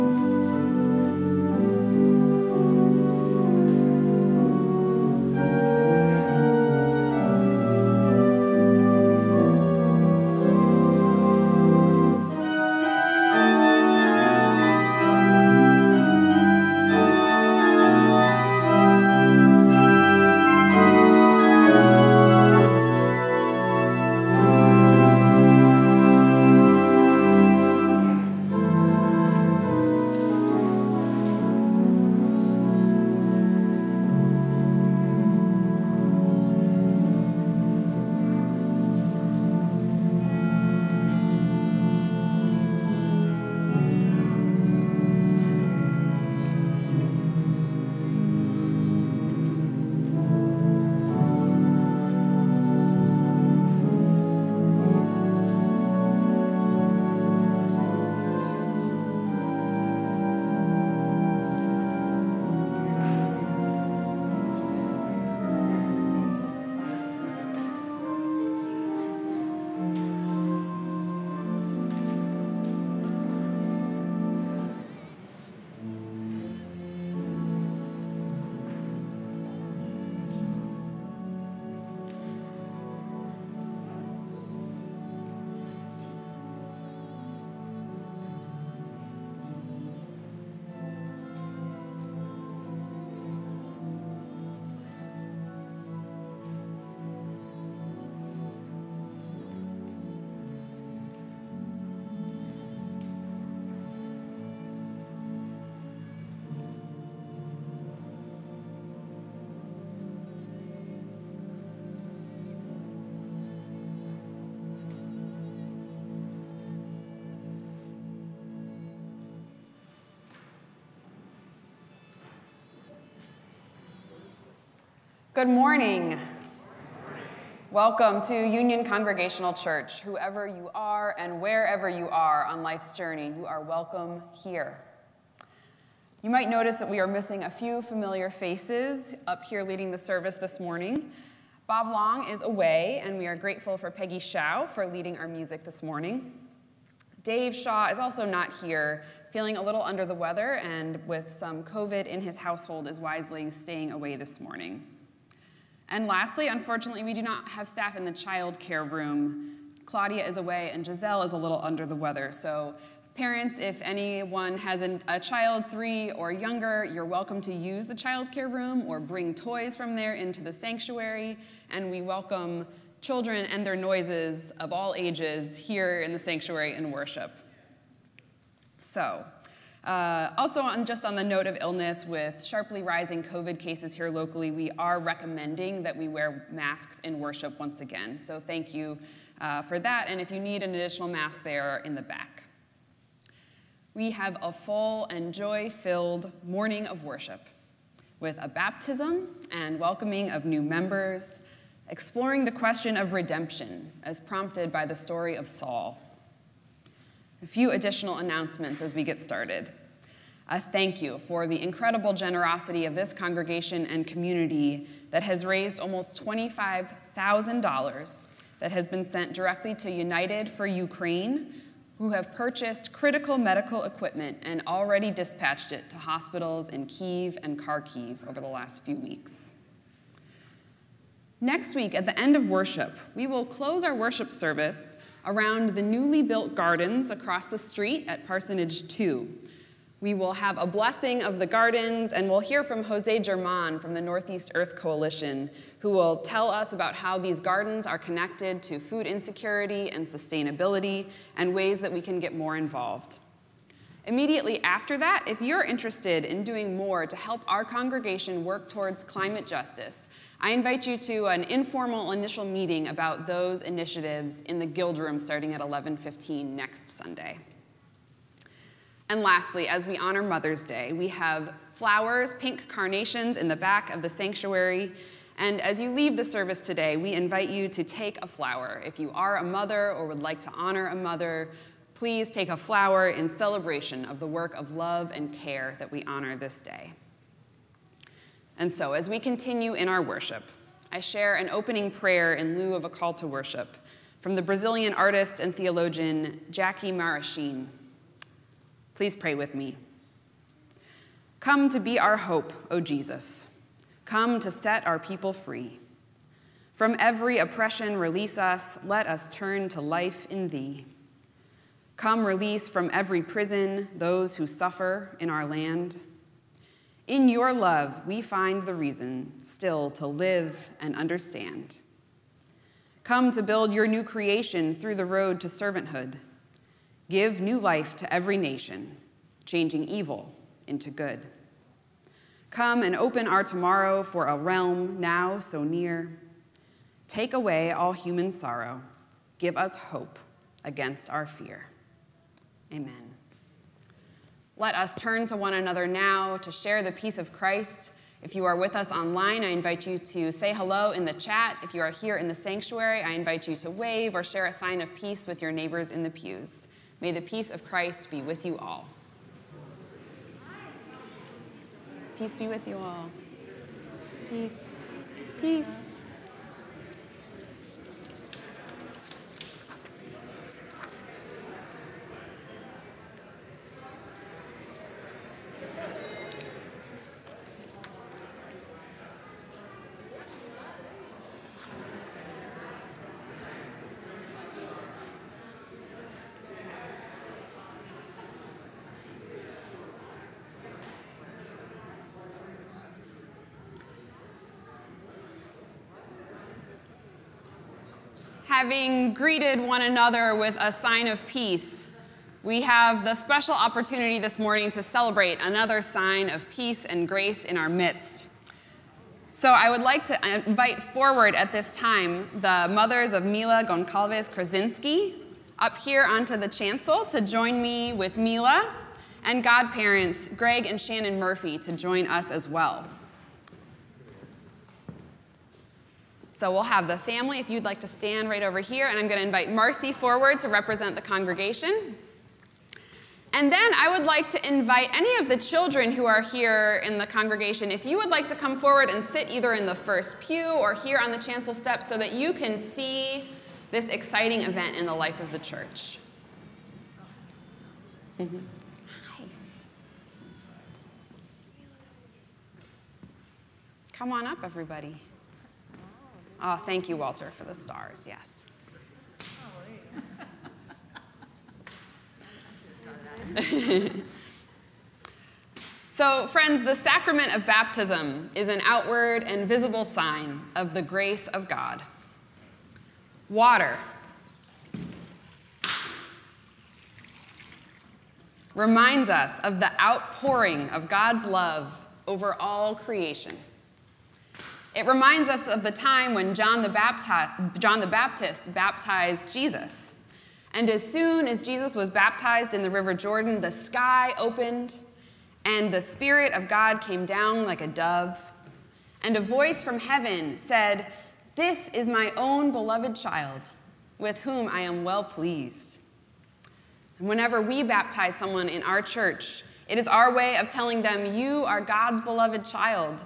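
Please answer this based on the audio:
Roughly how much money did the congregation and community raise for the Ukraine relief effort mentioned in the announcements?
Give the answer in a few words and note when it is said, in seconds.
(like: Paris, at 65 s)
$25,000, at 216 s.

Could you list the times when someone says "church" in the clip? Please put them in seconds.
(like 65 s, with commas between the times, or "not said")
129 s, 445 s, 508 s.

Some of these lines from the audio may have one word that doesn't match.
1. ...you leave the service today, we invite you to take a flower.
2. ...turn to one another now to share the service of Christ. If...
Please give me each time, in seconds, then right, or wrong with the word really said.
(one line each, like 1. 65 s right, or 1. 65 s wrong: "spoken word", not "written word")
1. 275 s right
2. 344 s wrong: "peace", not "service".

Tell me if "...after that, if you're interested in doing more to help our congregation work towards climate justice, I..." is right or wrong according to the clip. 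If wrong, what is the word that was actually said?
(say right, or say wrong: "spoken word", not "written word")
right.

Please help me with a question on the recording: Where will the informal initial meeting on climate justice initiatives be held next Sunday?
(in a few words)
the Guild Room.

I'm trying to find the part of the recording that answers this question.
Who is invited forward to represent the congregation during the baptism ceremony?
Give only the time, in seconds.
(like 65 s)
429 s.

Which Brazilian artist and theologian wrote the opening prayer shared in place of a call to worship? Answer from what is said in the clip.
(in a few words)
Jaci Maraschin.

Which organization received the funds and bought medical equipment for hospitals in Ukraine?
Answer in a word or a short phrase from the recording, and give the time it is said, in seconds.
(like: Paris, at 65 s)
United for Ukraine, at 219 s.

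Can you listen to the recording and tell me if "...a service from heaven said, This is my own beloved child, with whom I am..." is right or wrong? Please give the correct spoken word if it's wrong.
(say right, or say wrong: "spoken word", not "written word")
wrong: "voice", not "service".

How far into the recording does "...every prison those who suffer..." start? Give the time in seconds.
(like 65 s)
312 s.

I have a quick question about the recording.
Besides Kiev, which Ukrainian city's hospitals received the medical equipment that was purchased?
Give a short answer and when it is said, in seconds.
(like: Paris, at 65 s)
Kharkiv, at 227 s.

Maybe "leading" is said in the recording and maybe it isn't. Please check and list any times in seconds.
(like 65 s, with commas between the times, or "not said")
139 s, 144 s.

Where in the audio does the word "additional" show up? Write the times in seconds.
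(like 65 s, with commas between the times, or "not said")
190 s, 207 s.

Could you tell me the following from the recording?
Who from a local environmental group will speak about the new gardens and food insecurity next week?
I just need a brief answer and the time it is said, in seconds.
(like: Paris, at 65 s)
Jose German, at 242 s.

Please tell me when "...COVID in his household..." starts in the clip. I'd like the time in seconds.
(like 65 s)
151 s.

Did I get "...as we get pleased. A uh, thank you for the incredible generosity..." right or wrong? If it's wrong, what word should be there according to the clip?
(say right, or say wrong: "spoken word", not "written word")
wrong: "started", not "pleased".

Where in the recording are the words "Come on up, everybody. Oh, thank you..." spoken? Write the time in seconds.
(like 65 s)
453 s.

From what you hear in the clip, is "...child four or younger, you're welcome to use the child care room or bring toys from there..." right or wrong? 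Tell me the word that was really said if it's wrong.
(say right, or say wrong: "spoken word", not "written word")
wrong: "three", not "four".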